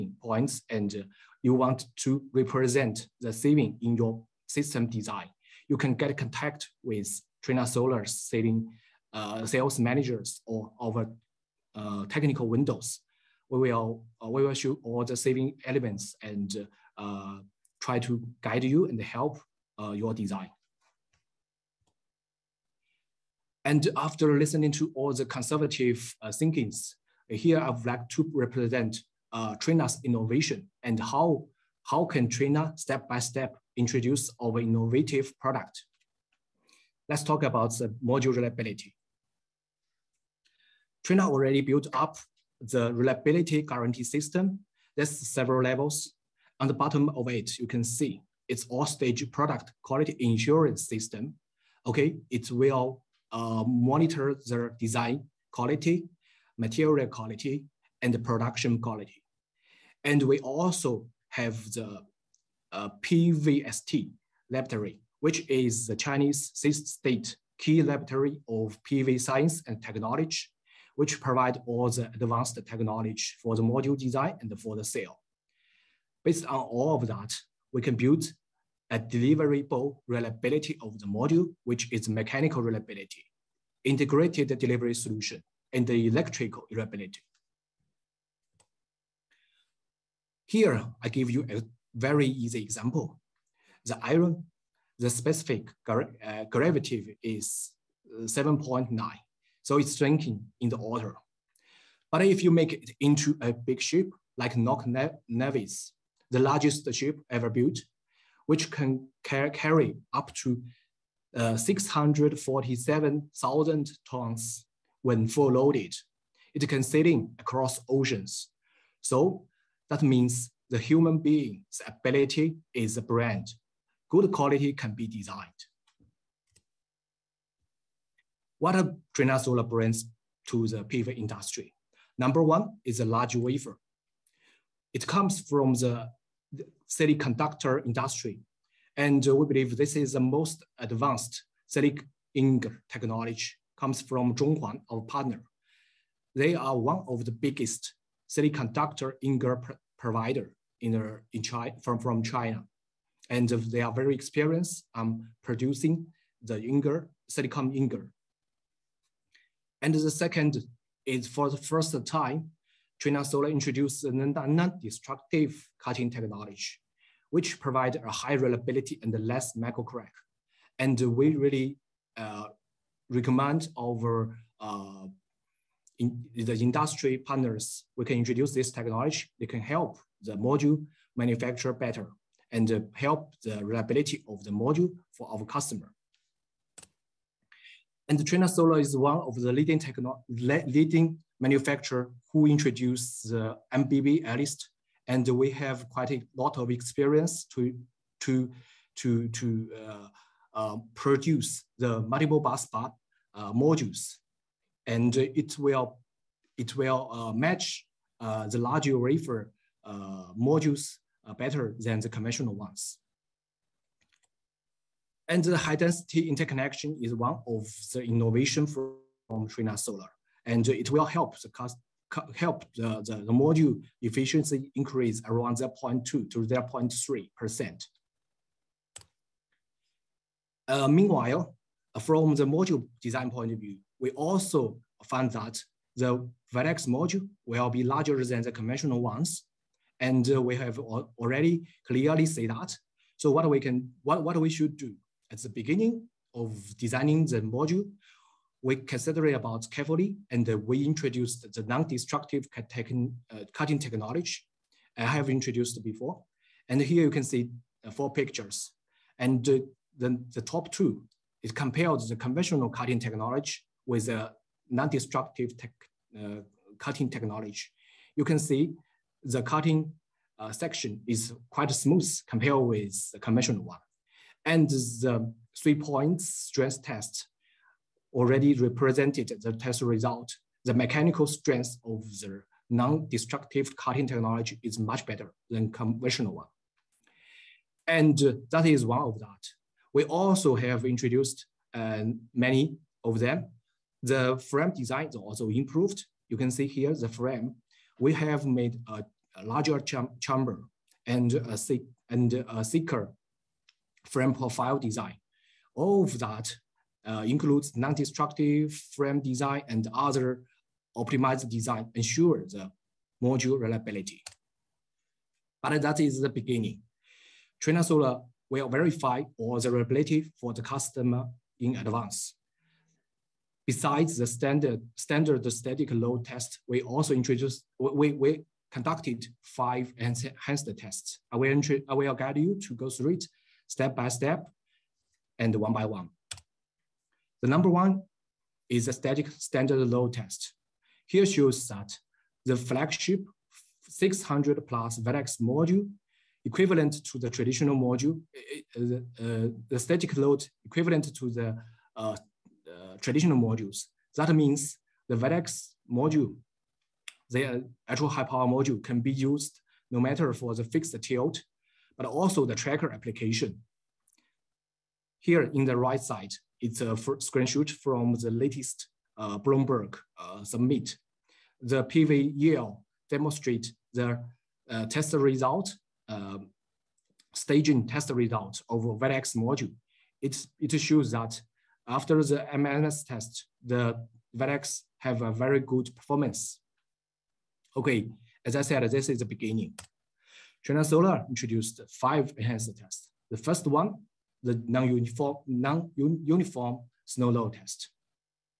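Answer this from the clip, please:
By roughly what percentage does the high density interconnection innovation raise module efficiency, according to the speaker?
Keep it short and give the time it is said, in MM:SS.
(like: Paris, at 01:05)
0.2 to 0.3%, at 03:45.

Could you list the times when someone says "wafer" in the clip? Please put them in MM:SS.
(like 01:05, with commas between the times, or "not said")
02:13, 03:28.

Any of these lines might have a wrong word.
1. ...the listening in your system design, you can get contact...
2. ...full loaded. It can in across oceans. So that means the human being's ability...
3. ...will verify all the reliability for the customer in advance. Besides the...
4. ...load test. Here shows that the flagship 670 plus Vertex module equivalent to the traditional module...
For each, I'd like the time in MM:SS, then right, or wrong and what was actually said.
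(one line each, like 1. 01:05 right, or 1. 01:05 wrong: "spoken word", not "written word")
1. 00:03 wrong: "saving", not "listening"
2. 01:55 right
3. 05:18 right
4. 05:39 wrong: "600", not "670".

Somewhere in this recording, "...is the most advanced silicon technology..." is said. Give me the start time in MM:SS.
02:19.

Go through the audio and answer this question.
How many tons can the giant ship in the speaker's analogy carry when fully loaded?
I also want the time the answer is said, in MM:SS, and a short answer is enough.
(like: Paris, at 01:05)
647,000 tons, at 01:51.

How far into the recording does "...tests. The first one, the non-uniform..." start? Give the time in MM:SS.
06:32.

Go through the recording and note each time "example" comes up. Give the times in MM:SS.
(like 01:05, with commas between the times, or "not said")
01:32.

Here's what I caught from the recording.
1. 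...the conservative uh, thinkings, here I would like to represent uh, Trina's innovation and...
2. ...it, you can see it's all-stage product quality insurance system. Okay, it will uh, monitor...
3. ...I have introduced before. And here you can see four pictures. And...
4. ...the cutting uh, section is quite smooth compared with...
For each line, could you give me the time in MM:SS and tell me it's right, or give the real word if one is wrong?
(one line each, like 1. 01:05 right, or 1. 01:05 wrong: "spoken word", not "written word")
1. 00:25 right
2. 00:47 right
3. 04:14 right
4. 04:29 right.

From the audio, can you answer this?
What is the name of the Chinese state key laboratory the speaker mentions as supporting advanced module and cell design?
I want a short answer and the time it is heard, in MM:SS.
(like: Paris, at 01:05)
PVST laboratory, at 01:03.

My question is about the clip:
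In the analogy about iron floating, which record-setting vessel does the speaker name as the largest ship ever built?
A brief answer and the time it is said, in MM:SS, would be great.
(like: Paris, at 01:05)
Knock Nevis, at 01:44.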